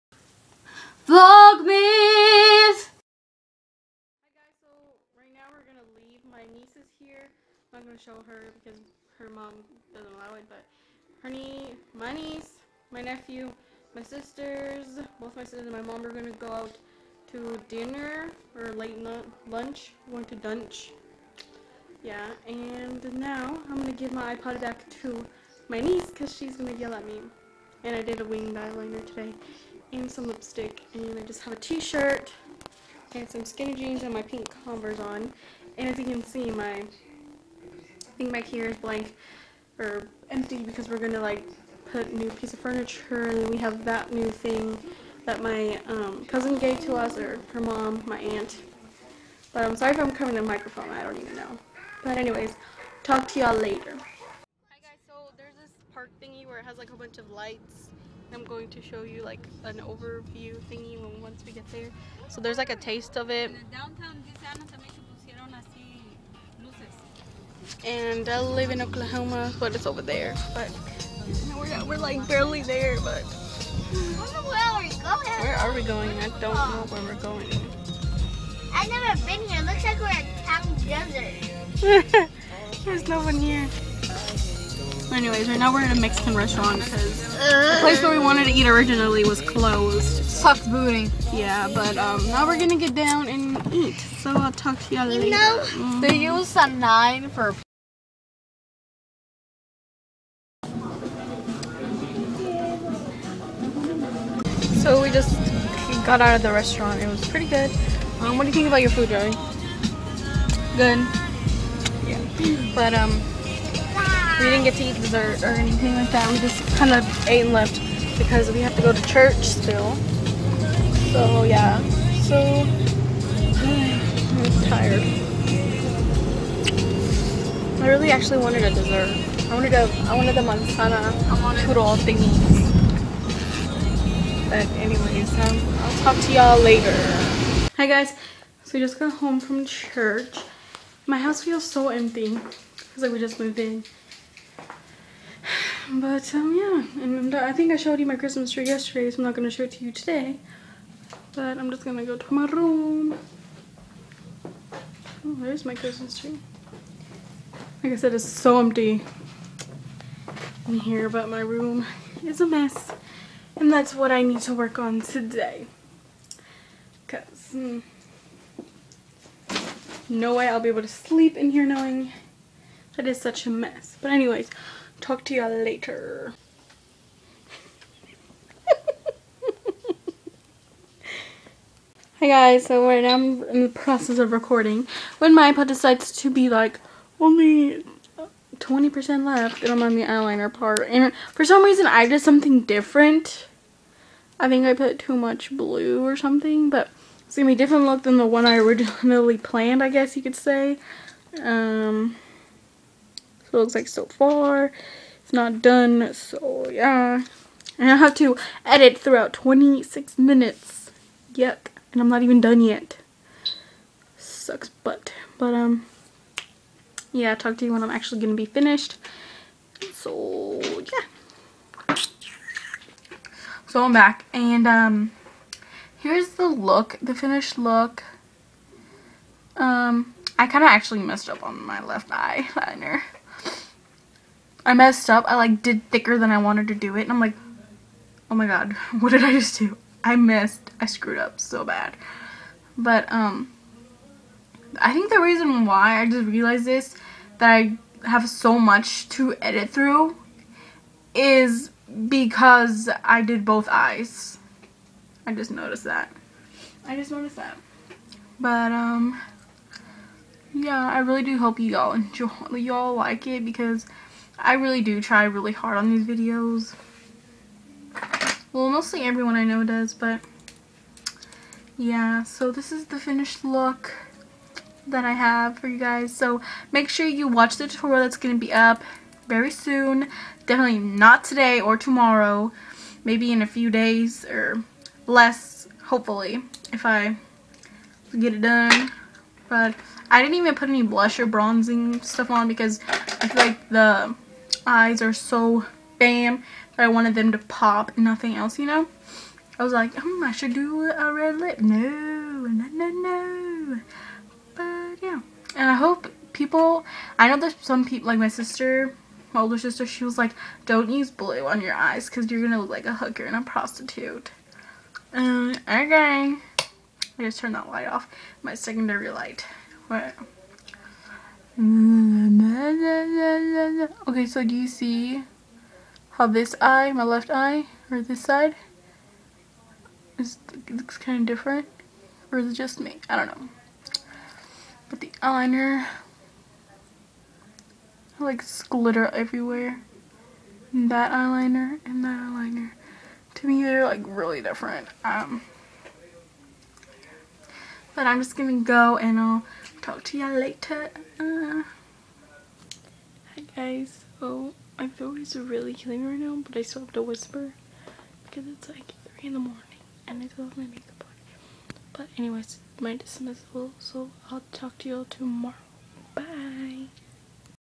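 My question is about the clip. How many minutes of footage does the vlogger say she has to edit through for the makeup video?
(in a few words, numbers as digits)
26.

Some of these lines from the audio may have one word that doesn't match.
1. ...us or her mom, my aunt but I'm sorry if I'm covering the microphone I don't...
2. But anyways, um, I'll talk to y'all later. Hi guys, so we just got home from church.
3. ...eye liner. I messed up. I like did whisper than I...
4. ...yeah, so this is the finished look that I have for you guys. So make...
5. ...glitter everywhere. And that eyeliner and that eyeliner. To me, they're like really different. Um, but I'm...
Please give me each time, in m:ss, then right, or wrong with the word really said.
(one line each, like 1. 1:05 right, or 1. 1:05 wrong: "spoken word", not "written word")
1. 0:46 right
2. 2:14 right
3. 3:52 wrong: "thicker", not "whisper"
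4. 4:31 right
5. 5:38 right.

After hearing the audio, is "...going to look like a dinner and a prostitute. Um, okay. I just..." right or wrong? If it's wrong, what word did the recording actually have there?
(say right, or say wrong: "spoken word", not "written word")
wrong: "hooker", not "dinner".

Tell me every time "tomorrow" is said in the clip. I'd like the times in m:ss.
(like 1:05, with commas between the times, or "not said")
4:41, 6:05.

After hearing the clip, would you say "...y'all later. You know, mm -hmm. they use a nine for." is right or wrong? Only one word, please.
right.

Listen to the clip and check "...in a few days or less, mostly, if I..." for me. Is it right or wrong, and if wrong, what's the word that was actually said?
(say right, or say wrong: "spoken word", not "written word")
wrong: "hopefully", not "mostly".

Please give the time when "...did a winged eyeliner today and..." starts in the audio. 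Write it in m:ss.
0:28.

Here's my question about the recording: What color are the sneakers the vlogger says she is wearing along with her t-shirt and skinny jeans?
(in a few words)
Pink.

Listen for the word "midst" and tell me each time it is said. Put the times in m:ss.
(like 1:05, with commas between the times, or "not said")
not said.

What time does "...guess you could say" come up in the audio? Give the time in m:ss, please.
3:19.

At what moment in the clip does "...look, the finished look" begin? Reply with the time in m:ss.
3:46.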